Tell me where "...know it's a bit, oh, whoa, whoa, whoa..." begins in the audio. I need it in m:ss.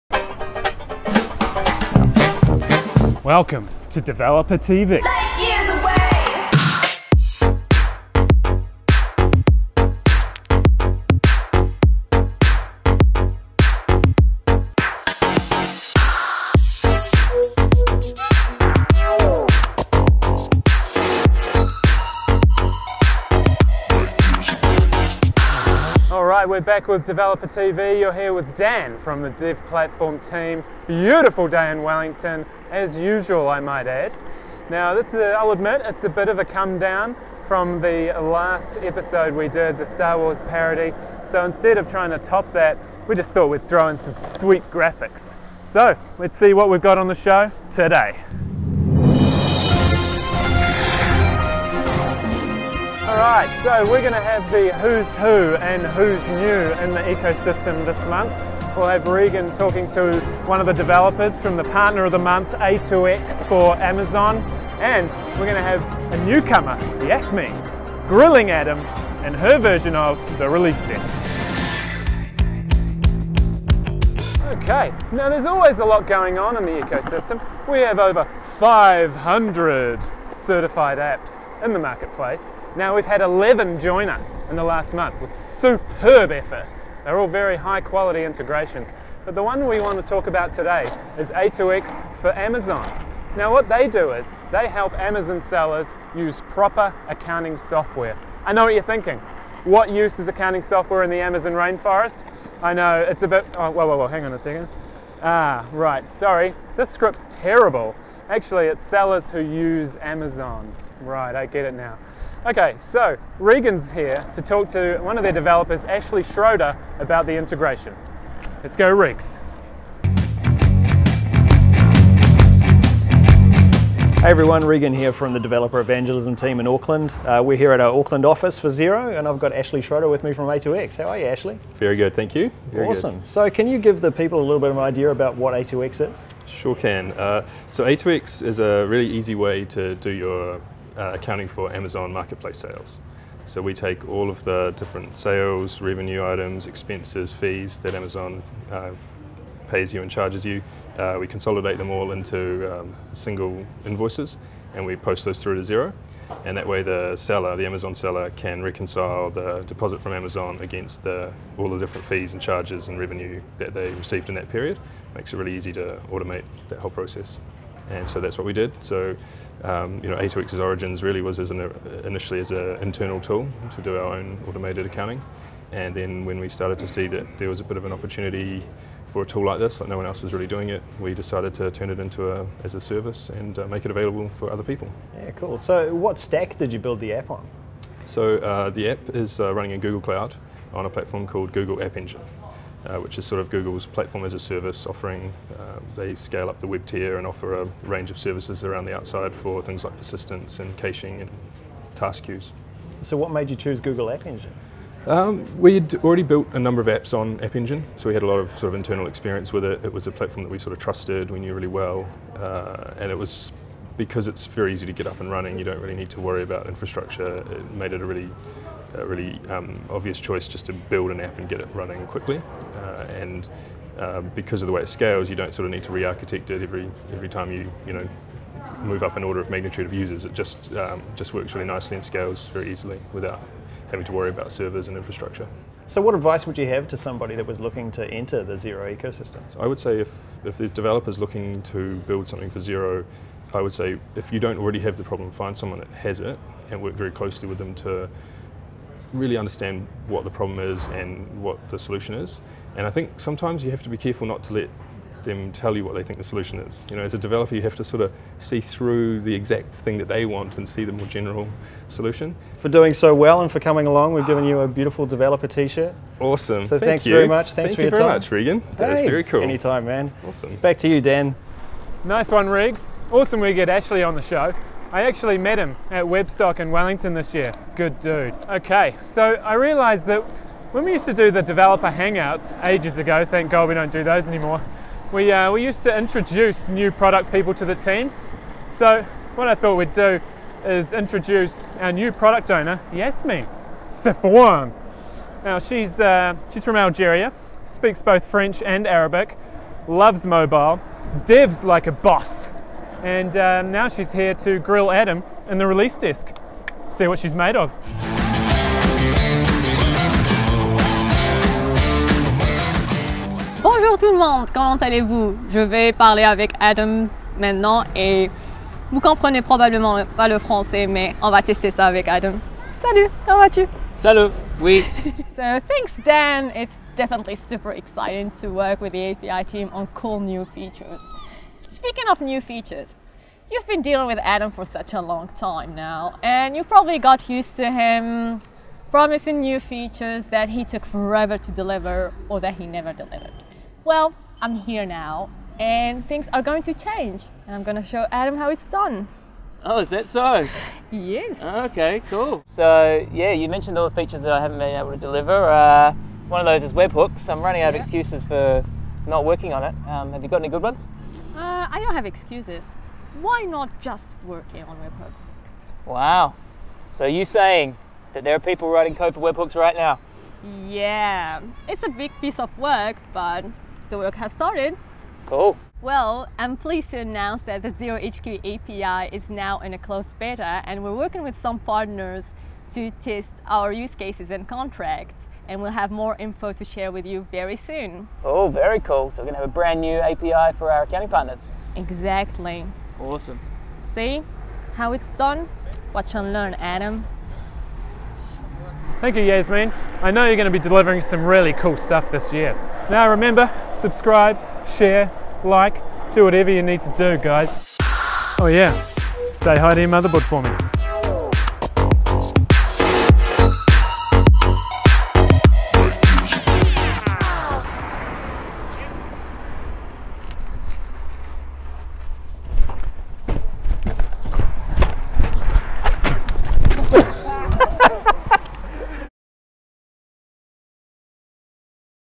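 1:42.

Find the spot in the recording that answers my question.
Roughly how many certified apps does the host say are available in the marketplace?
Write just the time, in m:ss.
1:17.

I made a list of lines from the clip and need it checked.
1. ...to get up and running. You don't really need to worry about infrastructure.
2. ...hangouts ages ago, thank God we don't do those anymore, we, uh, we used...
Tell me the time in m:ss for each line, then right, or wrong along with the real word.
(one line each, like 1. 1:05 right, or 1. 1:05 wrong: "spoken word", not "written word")
1. 3:34 right
2. 4:41 right.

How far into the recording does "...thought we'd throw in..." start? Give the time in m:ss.
0:43.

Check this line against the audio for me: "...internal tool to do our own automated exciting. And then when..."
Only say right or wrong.
wrong.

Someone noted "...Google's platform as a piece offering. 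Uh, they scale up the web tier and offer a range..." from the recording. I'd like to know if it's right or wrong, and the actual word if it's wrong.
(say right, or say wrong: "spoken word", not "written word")
wrong: "service", not "piece".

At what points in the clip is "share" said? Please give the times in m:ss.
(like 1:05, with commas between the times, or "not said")
6:26, 6:44.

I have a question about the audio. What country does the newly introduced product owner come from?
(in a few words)
Algeria.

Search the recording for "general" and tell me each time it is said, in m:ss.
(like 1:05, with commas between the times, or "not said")
4:21.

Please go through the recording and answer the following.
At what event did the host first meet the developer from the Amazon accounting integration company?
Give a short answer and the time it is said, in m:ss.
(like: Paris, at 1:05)
Webstock, at 4:36.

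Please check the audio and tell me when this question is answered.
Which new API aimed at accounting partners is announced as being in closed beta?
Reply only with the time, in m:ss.
6:17.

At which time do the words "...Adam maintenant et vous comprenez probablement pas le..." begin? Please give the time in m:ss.
5:16.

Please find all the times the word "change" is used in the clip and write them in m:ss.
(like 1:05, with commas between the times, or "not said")
5:46.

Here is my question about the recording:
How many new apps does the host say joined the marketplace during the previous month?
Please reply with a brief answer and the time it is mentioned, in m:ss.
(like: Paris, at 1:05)
11, at 1:23.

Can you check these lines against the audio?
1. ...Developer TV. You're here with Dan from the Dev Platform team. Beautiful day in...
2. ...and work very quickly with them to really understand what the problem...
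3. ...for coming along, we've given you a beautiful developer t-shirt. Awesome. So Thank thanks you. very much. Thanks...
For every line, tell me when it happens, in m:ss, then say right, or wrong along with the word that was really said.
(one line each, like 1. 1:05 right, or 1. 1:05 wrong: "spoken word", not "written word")
1. 0:27 right
2. 4:06 wrong: "closely", not "quickly"
3. 4:23 right.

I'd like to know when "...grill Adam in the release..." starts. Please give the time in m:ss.
5:04.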